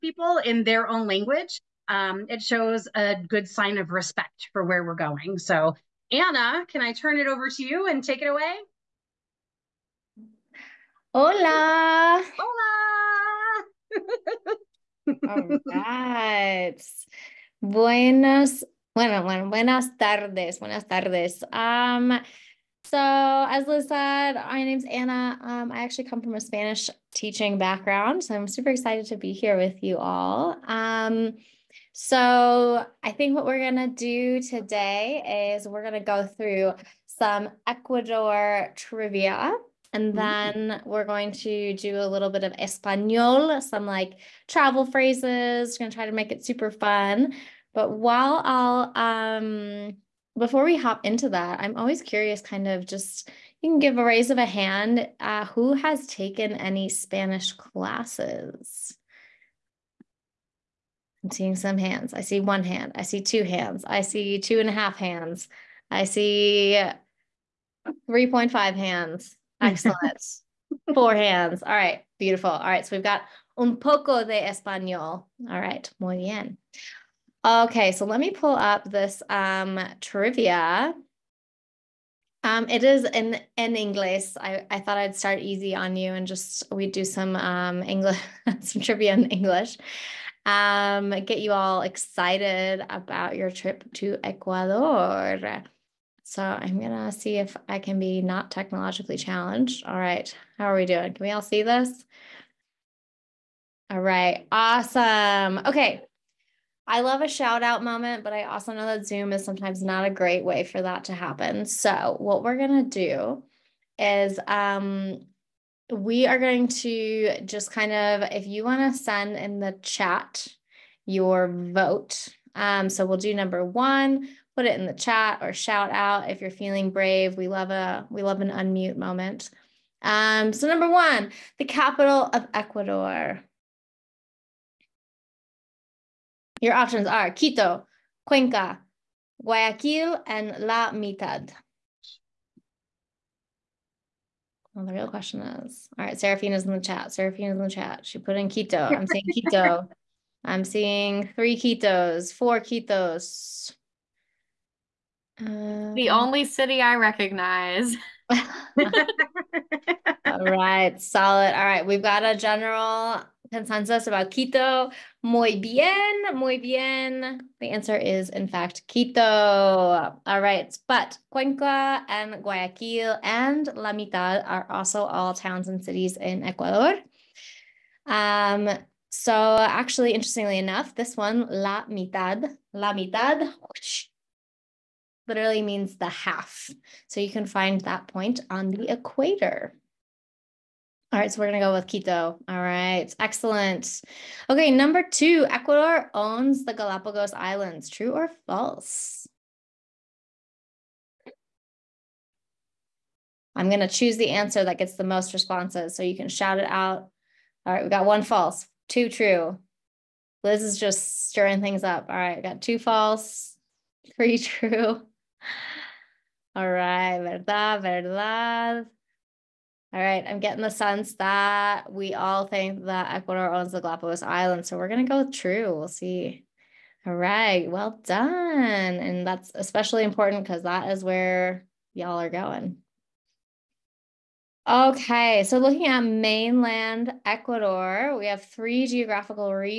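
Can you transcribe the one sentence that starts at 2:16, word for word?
Your options are Quito, Cuenca, Guayaquil, and La Mitad.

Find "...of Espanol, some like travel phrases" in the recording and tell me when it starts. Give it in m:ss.
0:42.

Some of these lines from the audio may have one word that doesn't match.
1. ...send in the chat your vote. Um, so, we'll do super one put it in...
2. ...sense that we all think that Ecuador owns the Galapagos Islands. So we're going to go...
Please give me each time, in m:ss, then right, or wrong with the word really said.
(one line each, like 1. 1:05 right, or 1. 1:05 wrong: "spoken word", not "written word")
1. 1:59 wrong: "number", not "super"
2. 3:40 right.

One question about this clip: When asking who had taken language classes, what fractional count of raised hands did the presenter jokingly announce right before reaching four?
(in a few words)
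3.5.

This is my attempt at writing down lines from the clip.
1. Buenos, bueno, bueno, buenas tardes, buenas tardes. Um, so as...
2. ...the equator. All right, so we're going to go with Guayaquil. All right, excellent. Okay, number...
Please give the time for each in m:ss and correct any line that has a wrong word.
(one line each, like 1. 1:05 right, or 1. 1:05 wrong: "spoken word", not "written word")
1. 0:17 right
2. 3:08 wrong: "Quito", not "Guayaquil".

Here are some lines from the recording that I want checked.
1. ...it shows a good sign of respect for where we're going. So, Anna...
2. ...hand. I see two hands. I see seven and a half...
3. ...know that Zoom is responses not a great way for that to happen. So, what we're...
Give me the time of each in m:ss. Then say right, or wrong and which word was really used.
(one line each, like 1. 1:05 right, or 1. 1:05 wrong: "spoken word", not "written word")
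1. 0:02 right
2. 1:02 wrong: "two", not "seven"
3. 1:48 wrong: "sometimes", not "responses".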